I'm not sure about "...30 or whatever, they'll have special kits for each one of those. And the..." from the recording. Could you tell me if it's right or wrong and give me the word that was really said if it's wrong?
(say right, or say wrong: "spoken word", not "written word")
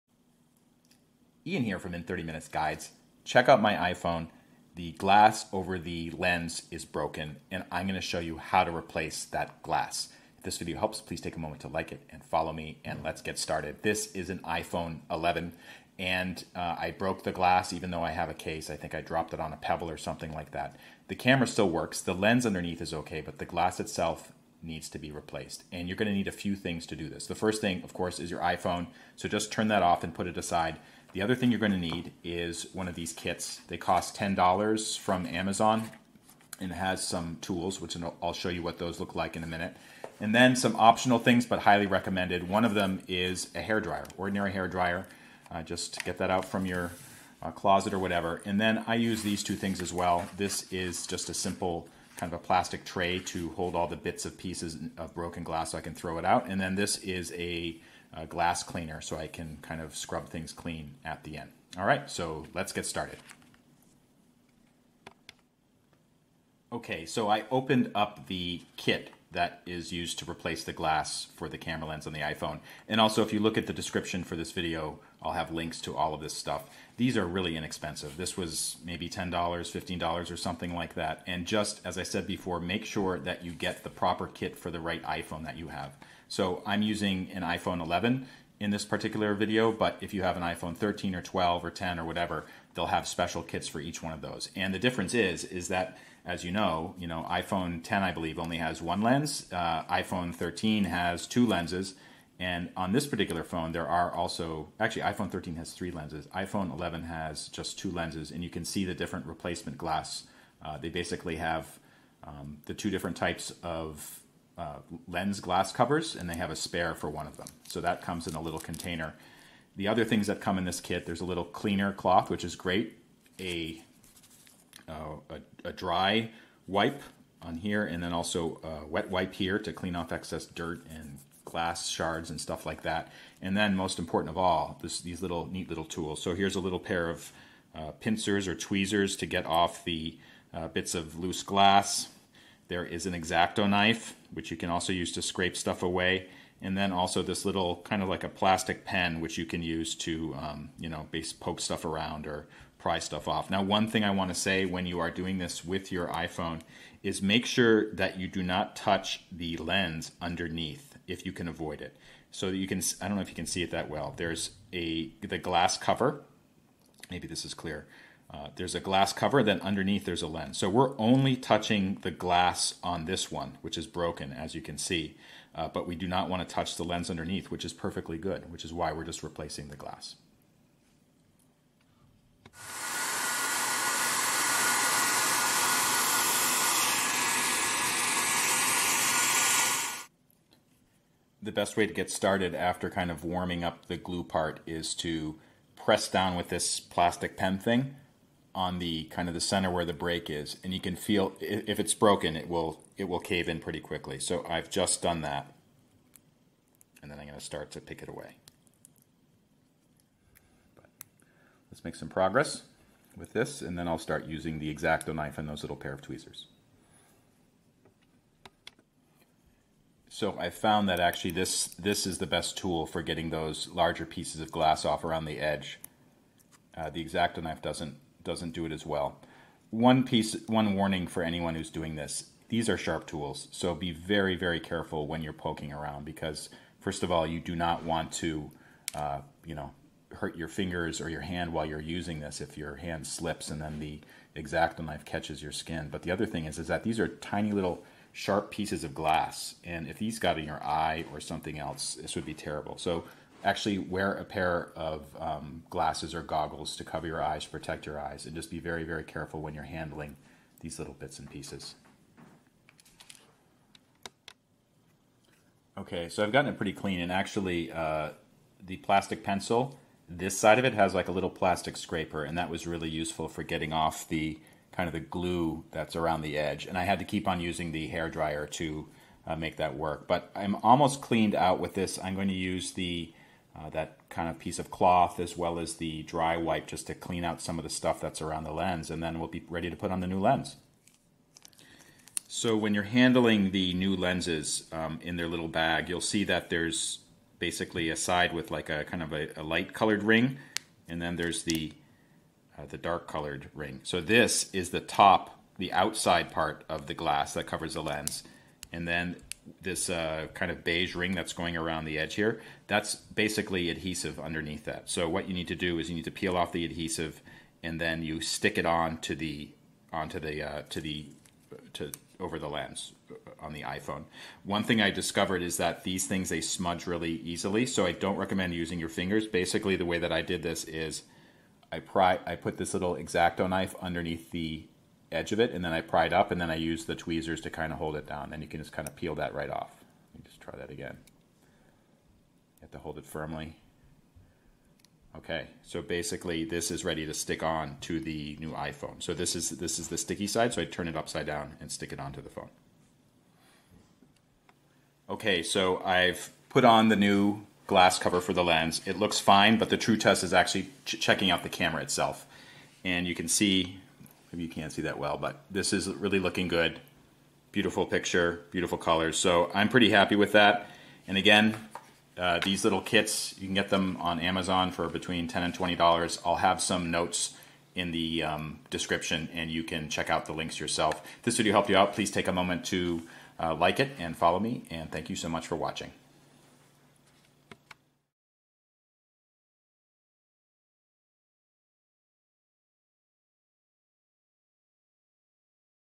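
wrong: "10", not "30".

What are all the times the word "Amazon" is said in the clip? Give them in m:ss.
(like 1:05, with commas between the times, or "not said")
0:35, 6:14.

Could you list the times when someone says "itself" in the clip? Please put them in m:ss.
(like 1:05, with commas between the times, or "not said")
0:23, 6:01.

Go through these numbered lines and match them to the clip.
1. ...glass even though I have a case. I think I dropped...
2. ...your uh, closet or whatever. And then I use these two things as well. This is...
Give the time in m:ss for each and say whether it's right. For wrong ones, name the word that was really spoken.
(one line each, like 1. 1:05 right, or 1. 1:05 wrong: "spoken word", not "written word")
1. 0:17 right
2. 0:46 right.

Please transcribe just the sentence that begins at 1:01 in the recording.
All right, so let's get started.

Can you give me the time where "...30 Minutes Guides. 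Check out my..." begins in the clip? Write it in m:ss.
0:02.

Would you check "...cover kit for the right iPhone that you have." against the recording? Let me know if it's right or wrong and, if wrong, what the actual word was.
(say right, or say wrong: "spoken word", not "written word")
wrong: "proper", not "cover".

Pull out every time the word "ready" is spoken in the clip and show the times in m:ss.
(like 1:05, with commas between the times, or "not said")
4:49, 5:46.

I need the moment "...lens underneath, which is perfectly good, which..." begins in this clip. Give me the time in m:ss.
2:56.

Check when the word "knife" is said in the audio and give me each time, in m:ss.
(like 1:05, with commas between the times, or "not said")
2:23, 3:35, 3:47, 4:04, 5:33.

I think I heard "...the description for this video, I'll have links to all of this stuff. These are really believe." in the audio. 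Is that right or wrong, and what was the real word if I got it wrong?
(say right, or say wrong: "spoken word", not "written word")
wrong: "inexpensive", not "believe".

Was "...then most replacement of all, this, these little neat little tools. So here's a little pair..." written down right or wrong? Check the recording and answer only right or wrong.
wrong.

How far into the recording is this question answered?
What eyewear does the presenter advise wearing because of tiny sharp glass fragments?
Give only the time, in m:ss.
4:15.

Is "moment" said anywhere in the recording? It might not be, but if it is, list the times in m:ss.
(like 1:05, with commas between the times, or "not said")
0:11, 6:22.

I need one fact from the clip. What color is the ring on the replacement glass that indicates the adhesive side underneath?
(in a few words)
Beige.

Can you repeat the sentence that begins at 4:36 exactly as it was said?
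And I had to keep on using the hair dryer to uh, make that work.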